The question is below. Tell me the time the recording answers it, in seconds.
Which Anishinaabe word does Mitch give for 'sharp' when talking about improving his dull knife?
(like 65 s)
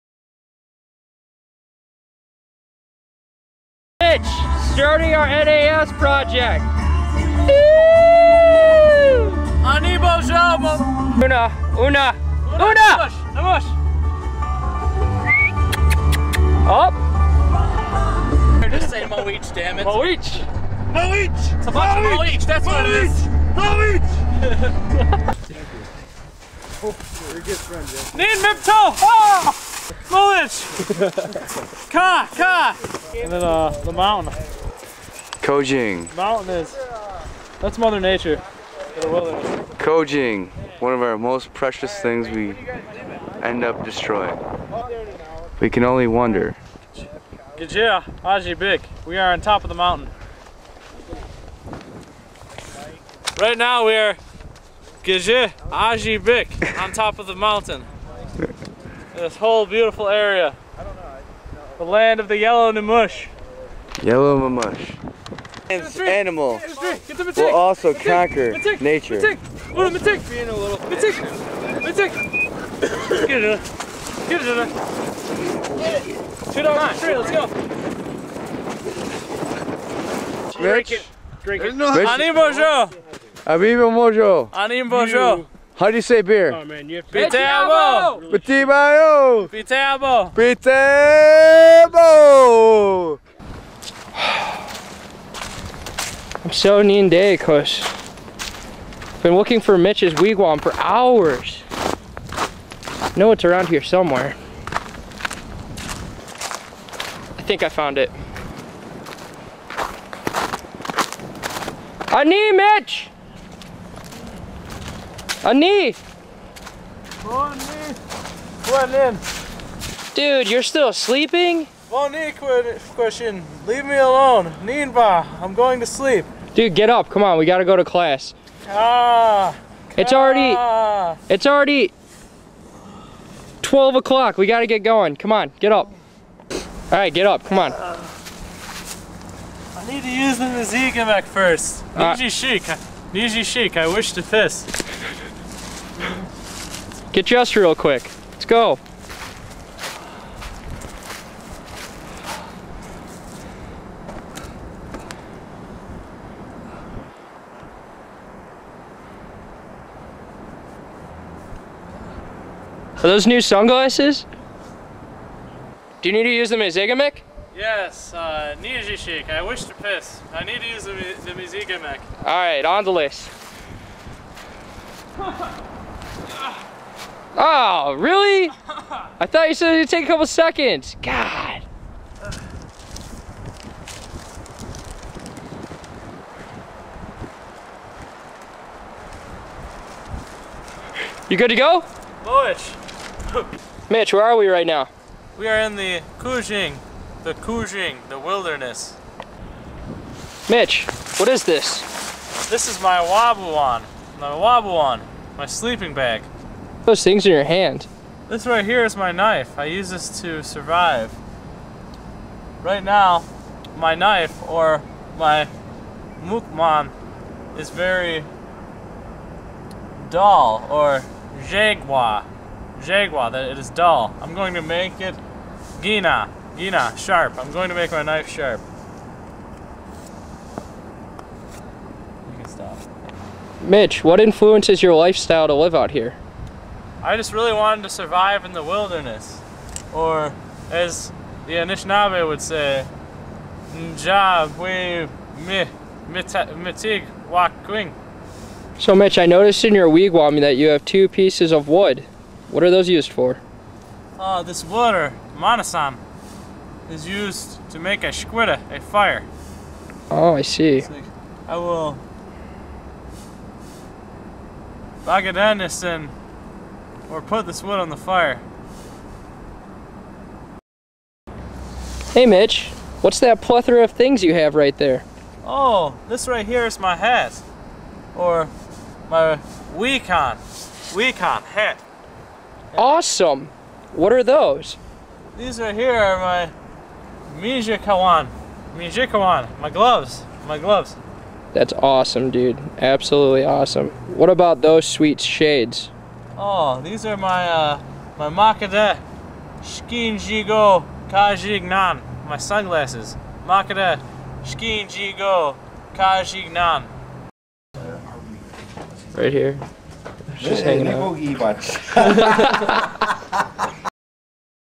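225 s.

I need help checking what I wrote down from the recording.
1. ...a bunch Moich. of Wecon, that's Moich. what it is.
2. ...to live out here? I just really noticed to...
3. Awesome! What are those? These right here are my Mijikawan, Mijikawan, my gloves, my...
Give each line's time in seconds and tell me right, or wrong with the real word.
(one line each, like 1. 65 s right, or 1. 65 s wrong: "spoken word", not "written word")
1. 21 s wrong: "Moich", not "Wecon"
2. 235 s wrong: "wanted", not "noticed"
3. 282 s right.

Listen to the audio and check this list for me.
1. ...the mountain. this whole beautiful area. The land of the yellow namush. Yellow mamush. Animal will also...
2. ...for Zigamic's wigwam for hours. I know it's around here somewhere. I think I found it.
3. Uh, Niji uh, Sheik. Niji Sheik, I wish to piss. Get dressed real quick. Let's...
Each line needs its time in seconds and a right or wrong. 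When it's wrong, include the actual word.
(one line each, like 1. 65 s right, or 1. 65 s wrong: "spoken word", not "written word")
1. 57 s right
2. 99 s wrong: "Mitch", not "Zigamic"
3. 141 s right.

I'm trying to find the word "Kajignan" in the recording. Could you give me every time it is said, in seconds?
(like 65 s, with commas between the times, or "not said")
301 s, 305 s.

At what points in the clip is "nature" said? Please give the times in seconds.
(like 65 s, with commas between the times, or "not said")
37 s, 68 s.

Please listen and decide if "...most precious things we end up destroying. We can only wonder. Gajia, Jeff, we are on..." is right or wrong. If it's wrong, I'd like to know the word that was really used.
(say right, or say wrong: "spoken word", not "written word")
wrong: "Ajibik", not "Jeff".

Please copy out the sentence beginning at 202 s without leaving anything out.
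This is my Wabuwan, my Wabuwan, my sleeping bag.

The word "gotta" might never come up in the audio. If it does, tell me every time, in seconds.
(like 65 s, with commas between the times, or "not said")
127 s, 134 s.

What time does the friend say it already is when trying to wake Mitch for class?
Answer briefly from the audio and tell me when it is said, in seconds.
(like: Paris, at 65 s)
12 o'clock, at 133 s.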